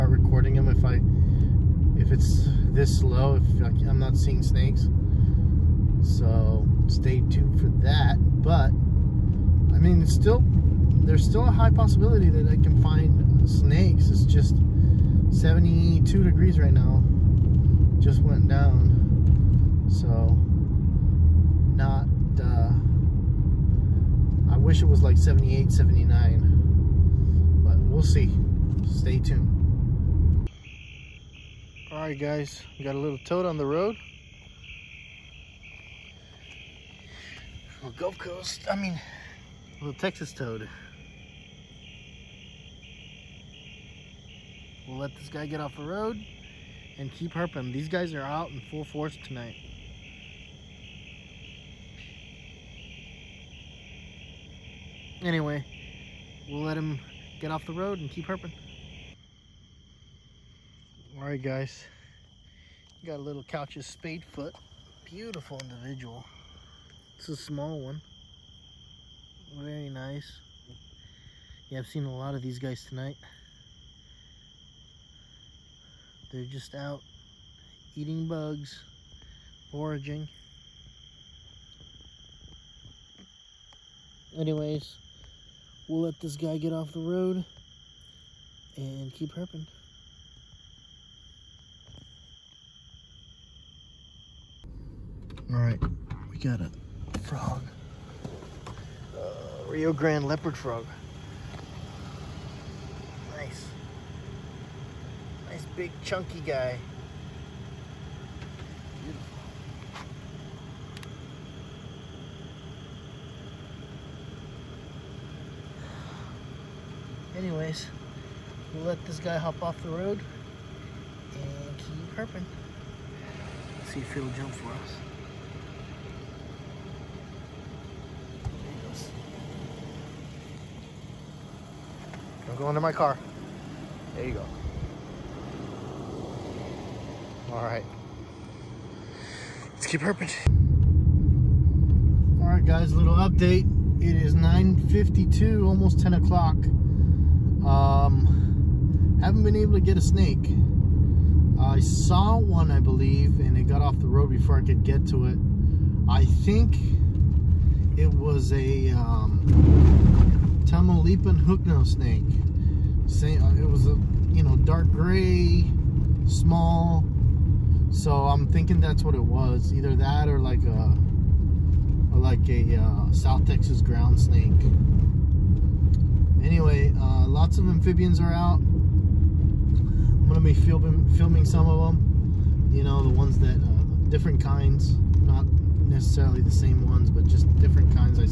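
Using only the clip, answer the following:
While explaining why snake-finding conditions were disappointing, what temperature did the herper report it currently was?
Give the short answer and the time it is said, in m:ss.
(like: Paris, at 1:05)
72 degrees, at 0:15.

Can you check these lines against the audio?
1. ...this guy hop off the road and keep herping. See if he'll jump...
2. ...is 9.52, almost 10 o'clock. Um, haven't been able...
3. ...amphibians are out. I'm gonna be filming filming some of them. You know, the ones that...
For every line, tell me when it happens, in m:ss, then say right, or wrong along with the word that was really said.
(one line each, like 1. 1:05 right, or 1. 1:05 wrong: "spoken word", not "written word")
1. 1:59 right
2. 2:24 right
3. 2:57 right.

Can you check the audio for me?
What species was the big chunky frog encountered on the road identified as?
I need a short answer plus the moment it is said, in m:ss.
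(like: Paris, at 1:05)
Rio Grande leopard frog, at 1:39.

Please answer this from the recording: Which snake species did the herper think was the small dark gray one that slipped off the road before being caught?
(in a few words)
Tamaulipan hooknose snake.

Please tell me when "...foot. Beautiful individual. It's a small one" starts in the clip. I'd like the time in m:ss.
1:04.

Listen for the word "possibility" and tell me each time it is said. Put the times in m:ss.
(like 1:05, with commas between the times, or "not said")
0:11.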